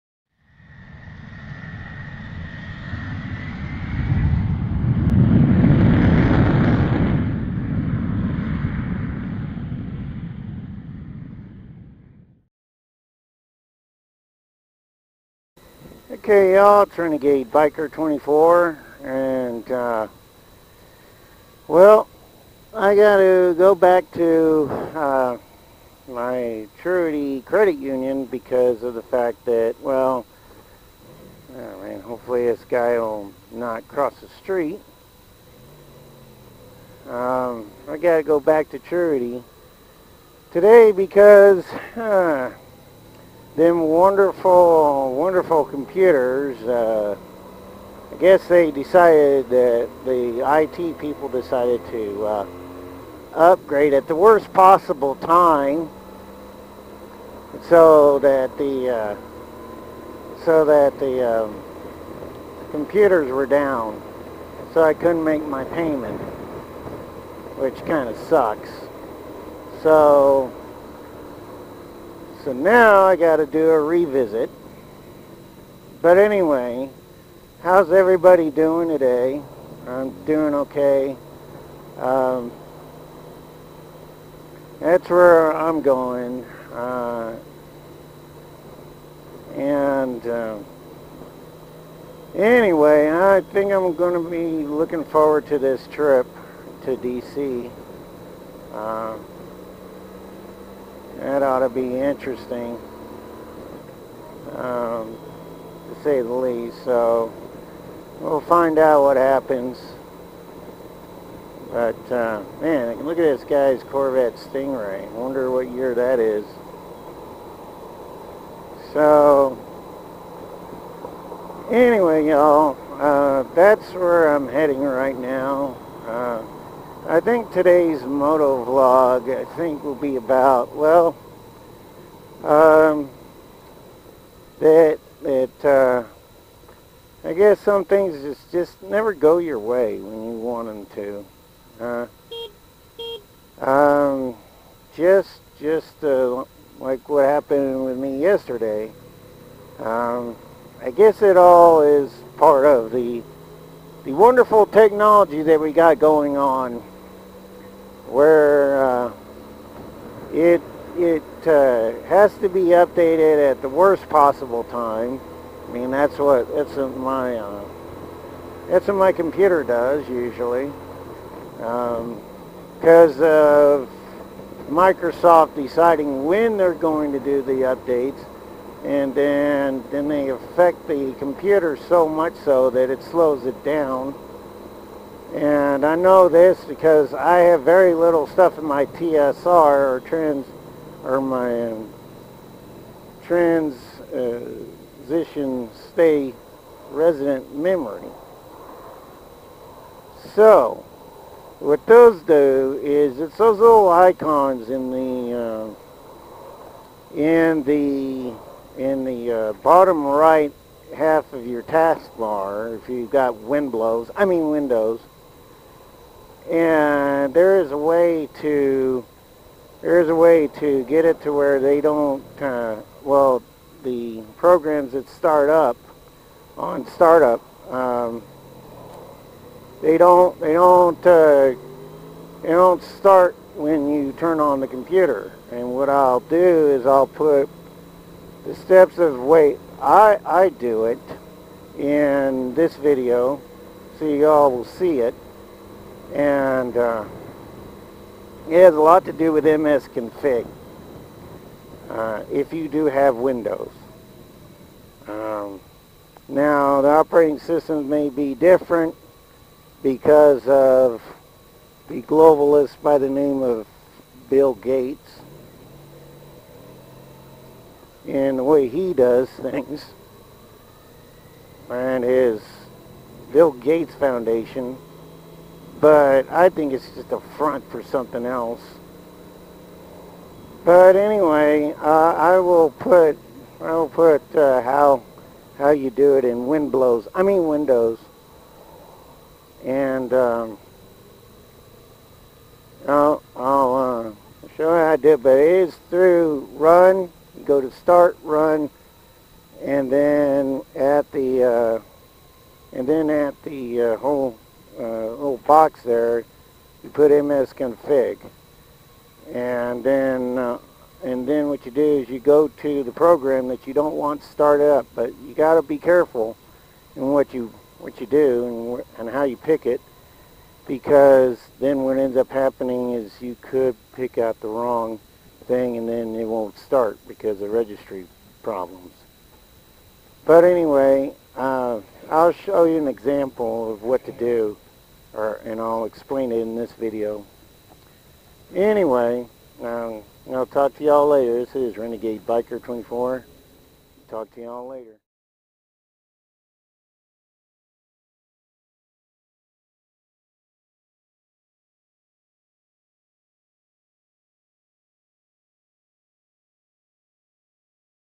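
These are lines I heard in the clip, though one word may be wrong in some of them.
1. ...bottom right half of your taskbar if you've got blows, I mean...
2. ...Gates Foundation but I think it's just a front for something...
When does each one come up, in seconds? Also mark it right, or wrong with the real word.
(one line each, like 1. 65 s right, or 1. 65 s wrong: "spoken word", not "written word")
1. 209 s right
2. 273 s right.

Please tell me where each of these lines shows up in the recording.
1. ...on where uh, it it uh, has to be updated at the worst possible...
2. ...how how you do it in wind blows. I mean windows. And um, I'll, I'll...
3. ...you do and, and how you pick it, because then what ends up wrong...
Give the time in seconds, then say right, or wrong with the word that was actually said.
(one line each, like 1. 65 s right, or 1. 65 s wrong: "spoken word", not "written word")
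1. 156 s right
2. 284 s right
3. 317 s wrong: "happening", not "wrong".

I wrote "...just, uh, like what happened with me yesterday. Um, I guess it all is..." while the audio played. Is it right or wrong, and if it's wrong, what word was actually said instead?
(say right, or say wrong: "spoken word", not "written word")
right.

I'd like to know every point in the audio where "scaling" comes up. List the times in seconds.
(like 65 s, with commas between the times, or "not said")
not said.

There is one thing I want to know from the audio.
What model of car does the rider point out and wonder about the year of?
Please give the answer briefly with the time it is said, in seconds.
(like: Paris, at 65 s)
Corvette Stingray, at 113 s.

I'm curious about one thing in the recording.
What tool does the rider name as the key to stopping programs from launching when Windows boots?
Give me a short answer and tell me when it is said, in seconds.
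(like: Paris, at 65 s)
MS config, at 249 s.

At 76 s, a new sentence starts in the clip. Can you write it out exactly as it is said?
But anyway, how's everybody doing today?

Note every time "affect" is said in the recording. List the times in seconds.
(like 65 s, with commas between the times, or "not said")
180 s.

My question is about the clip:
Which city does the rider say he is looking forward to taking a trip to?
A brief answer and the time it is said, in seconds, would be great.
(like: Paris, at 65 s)
D.C., at 96 s.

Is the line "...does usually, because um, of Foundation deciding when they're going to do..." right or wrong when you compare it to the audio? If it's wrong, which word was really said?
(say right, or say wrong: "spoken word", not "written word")
wrong: "Microsoft", not "Foundation".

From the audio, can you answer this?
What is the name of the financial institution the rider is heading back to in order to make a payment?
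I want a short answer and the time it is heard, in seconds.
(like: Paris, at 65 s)
Truity Credit Union, at 26 s.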